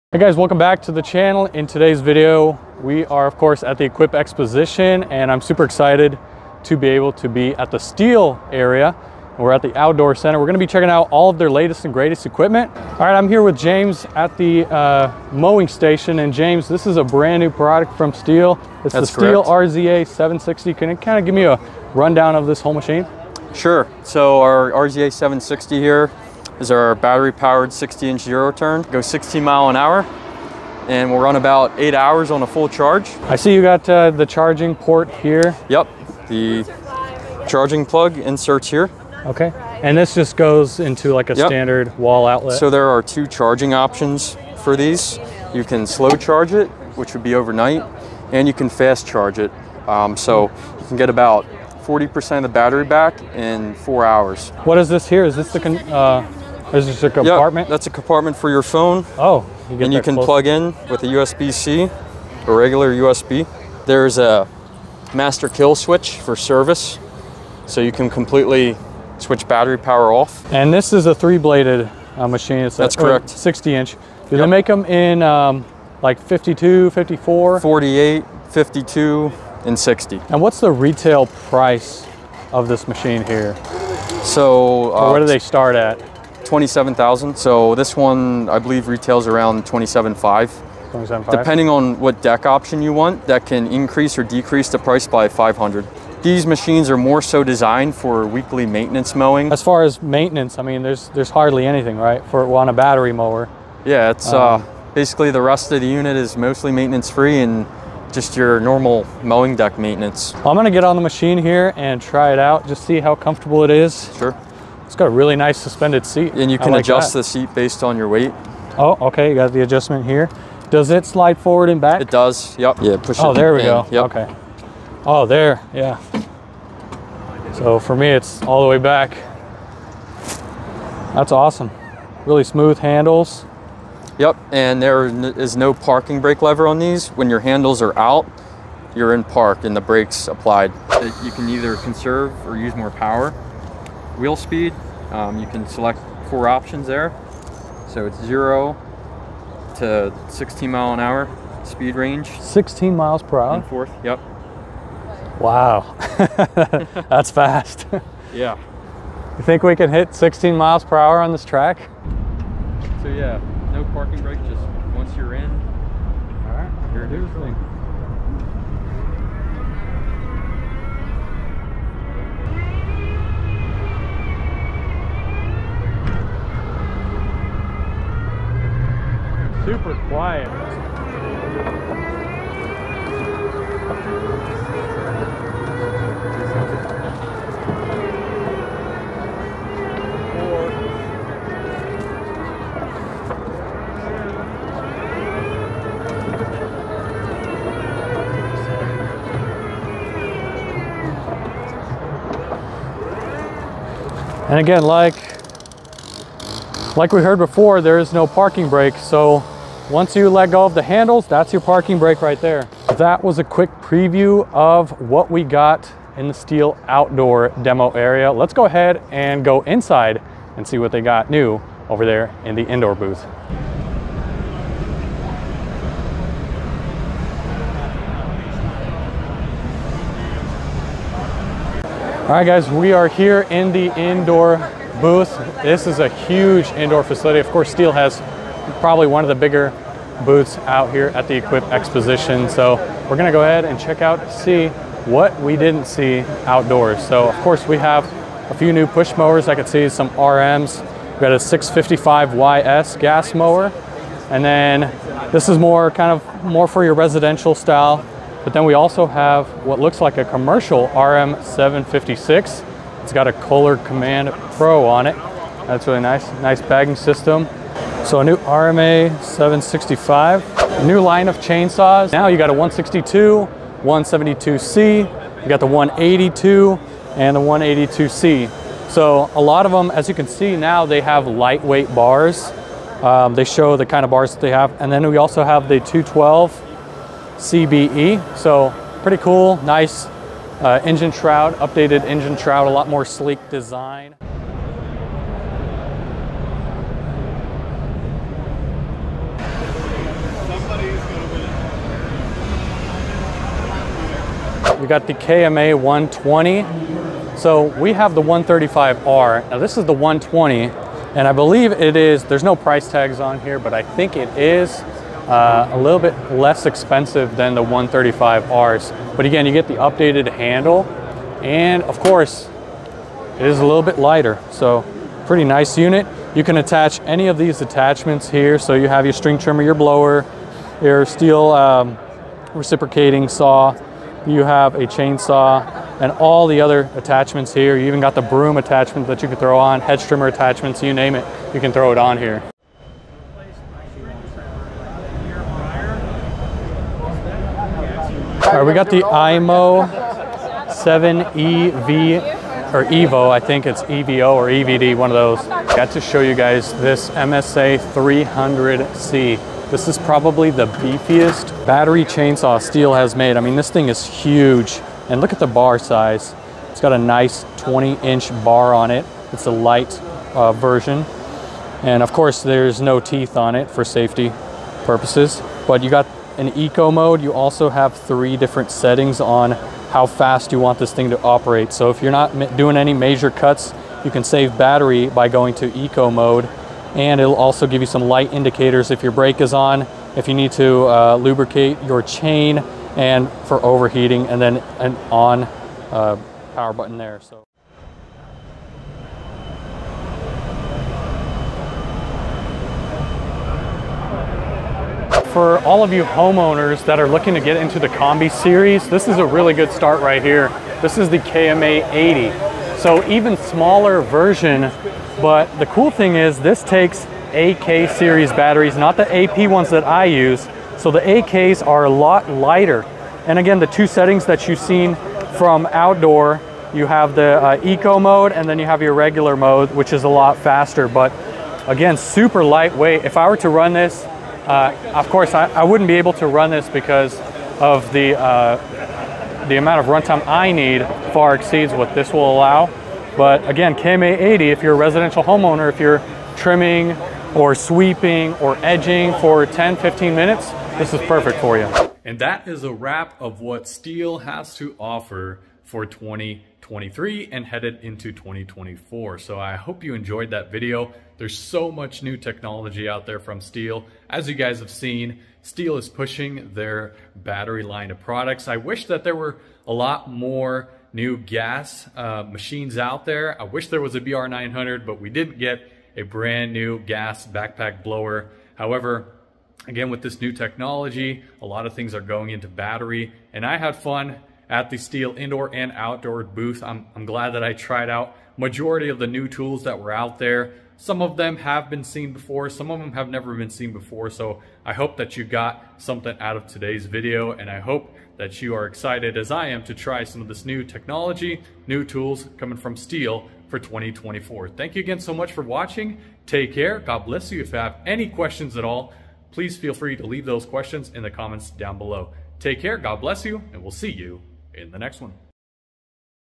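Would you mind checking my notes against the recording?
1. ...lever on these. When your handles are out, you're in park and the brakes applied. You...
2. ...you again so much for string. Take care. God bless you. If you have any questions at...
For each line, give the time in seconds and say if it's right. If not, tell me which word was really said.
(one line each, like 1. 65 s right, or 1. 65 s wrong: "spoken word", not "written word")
1. 136 s right
2. 504 s wrong: "watching", not "string".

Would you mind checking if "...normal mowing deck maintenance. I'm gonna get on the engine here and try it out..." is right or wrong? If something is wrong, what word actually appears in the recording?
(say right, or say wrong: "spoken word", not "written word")
wrong: "machine", not "engine".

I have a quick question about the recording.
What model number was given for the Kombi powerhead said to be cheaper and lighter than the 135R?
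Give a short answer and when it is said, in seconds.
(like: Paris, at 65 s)
KMA 120, at 305 s.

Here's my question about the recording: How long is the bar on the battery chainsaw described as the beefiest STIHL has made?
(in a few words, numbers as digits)
20 inch.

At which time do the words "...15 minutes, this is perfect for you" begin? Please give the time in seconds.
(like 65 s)
449 s.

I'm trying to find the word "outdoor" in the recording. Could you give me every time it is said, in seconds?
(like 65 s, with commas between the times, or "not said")
9 s, 216 s, 246 s, 425 s, 485 s.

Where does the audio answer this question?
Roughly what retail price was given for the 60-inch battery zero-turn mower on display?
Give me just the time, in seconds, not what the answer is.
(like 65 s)
89 s.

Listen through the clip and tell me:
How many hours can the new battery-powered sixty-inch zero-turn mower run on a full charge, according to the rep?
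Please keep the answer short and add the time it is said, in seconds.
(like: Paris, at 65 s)
8 hours, at 31 s.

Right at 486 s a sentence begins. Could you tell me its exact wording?
I'm, I'm glad that I tried out majority of the new tools that were out there.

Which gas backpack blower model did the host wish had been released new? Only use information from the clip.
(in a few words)
BR900.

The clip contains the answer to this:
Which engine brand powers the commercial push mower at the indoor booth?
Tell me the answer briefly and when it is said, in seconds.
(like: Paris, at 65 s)
Kohler Command Pro, at 263 s.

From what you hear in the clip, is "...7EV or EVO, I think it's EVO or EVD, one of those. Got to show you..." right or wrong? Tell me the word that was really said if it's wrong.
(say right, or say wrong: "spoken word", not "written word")
right.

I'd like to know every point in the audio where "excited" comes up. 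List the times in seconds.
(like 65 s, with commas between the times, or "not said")
5 s, 498 s.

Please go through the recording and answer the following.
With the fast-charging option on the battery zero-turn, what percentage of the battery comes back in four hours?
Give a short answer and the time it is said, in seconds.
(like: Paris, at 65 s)
40%, at 51 s.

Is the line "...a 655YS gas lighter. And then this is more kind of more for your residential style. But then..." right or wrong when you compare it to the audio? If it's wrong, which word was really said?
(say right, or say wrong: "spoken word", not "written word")
wrong: "mower", not "lighter".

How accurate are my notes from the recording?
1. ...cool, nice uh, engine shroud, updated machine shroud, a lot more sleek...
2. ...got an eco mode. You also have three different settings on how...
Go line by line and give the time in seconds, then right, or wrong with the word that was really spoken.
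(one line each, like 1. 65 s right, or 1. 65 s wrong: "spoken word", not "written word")
1. 289 s wrong: "engine", not "machine"
2. 375 s right.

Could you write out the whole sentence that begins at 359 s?
This is probably the beefiest battery chainsaw STIHL has made.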